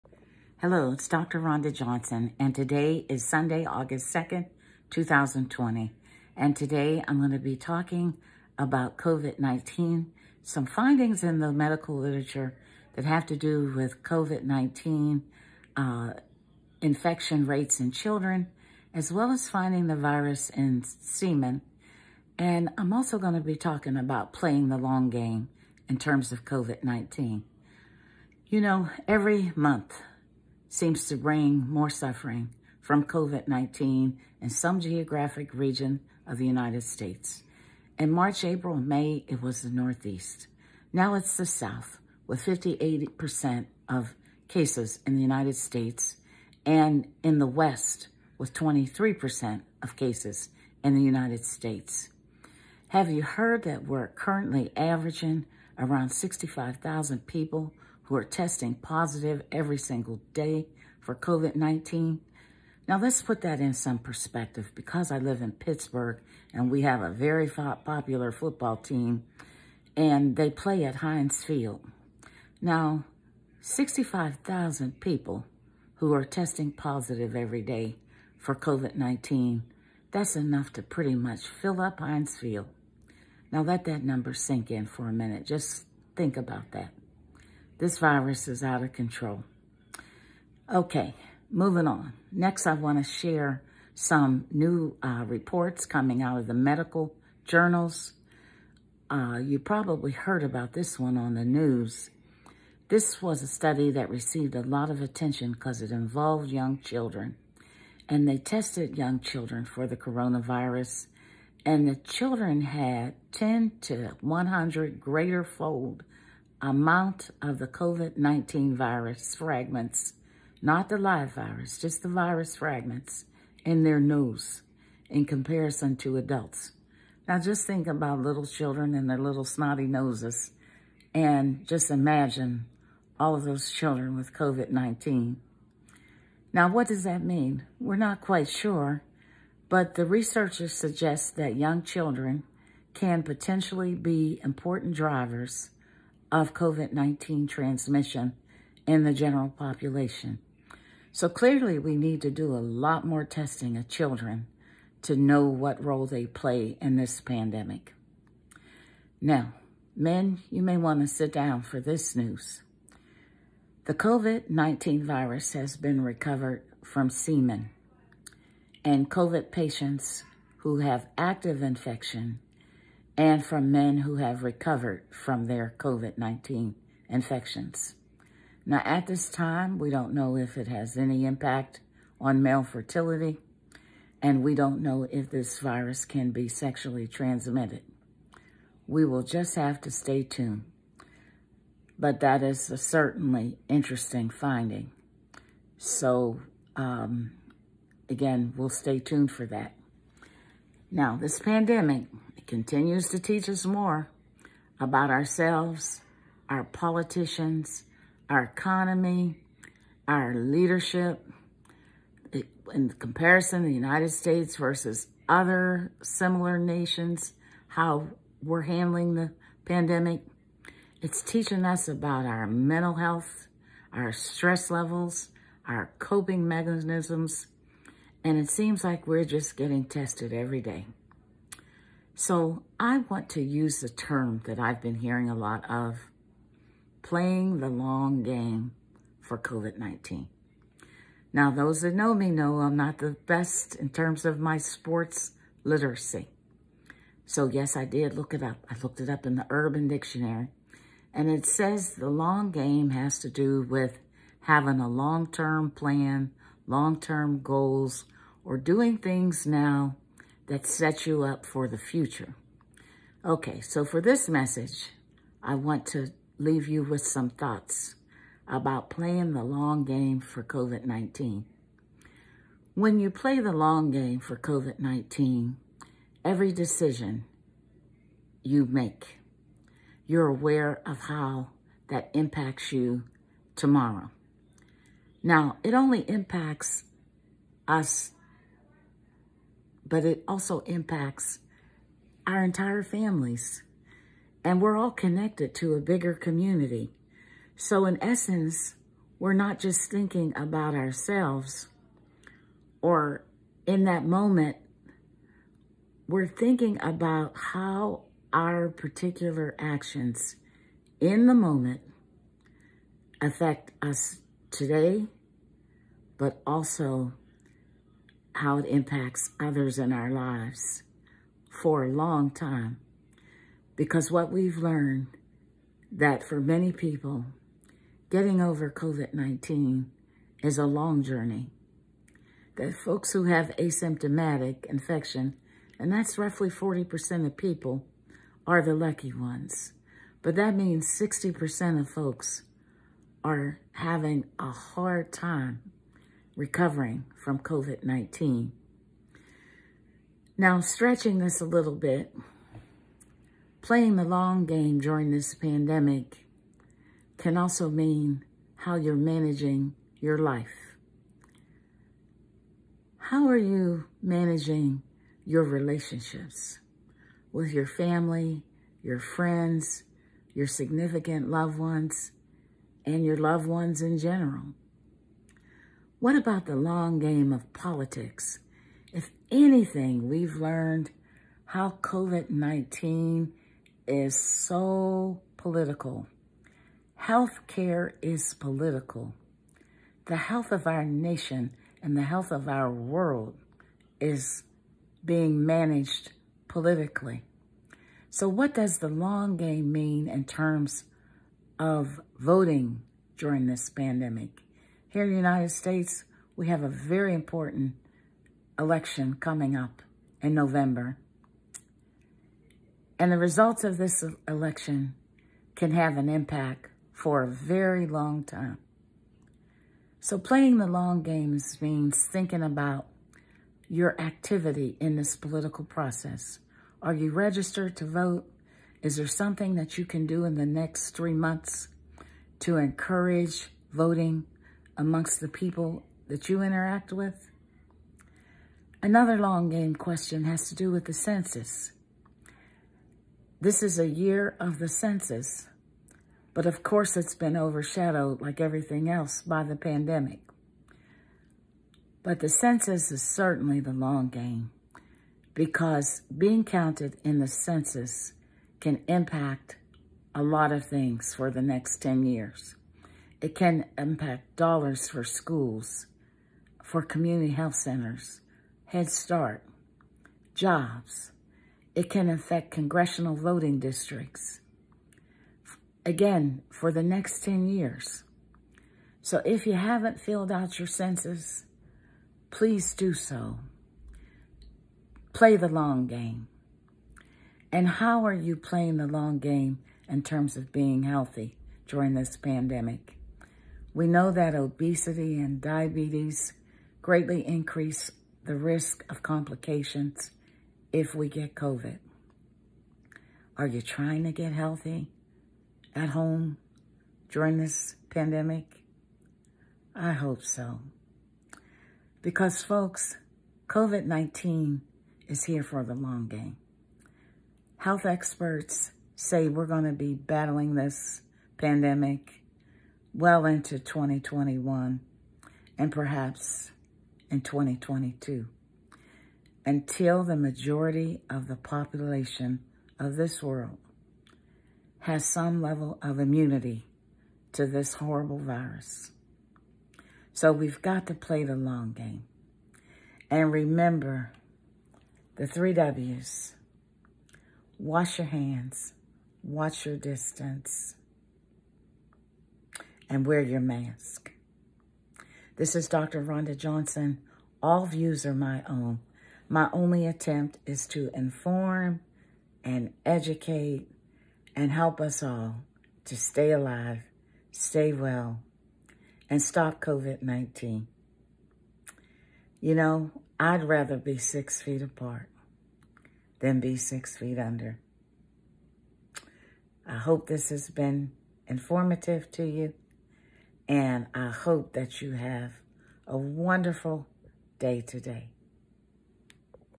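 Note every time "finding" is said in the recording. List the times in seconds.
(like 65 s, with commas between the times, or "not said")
10 s, 19 s, 194 s.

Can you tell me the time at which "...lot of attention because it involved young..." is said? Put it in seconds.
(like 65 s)
104 s.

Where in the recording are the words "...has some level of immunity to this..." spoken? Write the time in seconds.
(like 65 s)
534 s.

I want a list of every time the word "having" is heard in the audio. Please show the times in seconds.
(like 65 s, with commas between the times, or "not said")
254 s, 343 s.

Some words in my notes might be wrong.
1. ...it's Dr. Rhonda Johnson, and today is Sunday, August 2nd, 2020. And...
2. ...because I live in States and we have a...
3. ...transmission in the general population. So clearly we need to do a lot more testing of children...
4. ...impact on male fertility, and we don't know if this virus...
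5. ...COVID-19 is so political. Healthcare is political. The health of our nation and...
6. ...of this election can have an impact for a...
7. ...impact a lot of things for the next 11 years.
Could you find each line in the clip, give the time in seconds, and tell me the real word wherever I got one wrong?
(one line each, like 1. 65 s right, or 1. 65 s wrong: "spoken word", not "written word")
1. 0 s right
2. 64 s wrong: "Pittsburgh", not "States"
3. 147 s right
4. 181 s right
5. 381 s right
6. 413 s right
7. 458 s wrong: "10", not "11".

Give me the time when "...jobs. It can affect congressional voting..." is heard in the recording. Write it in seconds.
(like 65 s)
470 s.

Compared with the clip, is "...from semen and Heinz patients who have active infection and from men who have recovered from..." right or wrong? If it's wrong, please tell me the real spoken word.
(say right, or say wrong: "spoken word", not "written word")
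wrong: "COVID", not "Heinz".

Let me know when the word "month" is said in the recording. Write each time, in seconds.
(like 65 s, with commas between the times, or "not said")
29 s, 431 s.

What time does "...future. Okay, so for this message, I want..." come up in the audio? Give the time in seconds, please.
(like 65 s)
261 s.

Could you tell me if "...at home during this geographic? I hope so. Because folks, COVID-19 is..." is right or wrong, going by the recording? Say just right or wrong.
wrong.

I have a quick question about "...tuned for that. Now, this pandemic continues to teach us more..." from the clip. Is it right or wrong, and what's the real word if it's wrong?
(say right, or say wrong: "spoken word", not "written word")
right.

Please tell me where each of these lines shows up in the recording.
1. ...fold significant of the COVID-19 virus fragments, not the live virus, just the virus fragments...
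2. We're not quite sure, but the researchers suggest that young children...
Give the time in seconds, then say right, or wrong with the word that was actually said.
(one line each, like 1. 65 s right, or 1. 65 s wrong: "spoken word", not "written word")
1. 115 s wrong: "amount", not "significant"
2. 137 s right.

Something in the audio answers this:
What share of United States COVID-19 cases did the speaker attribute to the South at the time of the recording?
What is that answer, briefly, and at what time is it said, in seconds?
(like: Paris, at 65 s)
58%, at 42 s.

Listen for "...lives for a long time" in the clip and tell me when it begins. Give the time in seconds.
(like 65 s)
320 s.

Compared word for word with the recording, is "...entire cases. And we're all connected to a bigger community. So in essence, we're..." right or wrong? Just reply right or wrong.
wrong.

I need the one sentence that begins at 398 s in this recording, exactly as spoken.
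So what does the long game mean in terms of voting during this pandemic?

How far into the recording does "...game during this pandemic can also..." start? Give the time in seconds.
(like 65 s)
354 s.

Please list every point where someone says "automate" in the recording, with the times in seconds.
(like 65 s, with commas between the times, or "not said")
not said.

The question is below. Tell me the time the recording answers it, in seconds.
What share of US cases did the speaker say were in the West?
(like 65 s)
48 s.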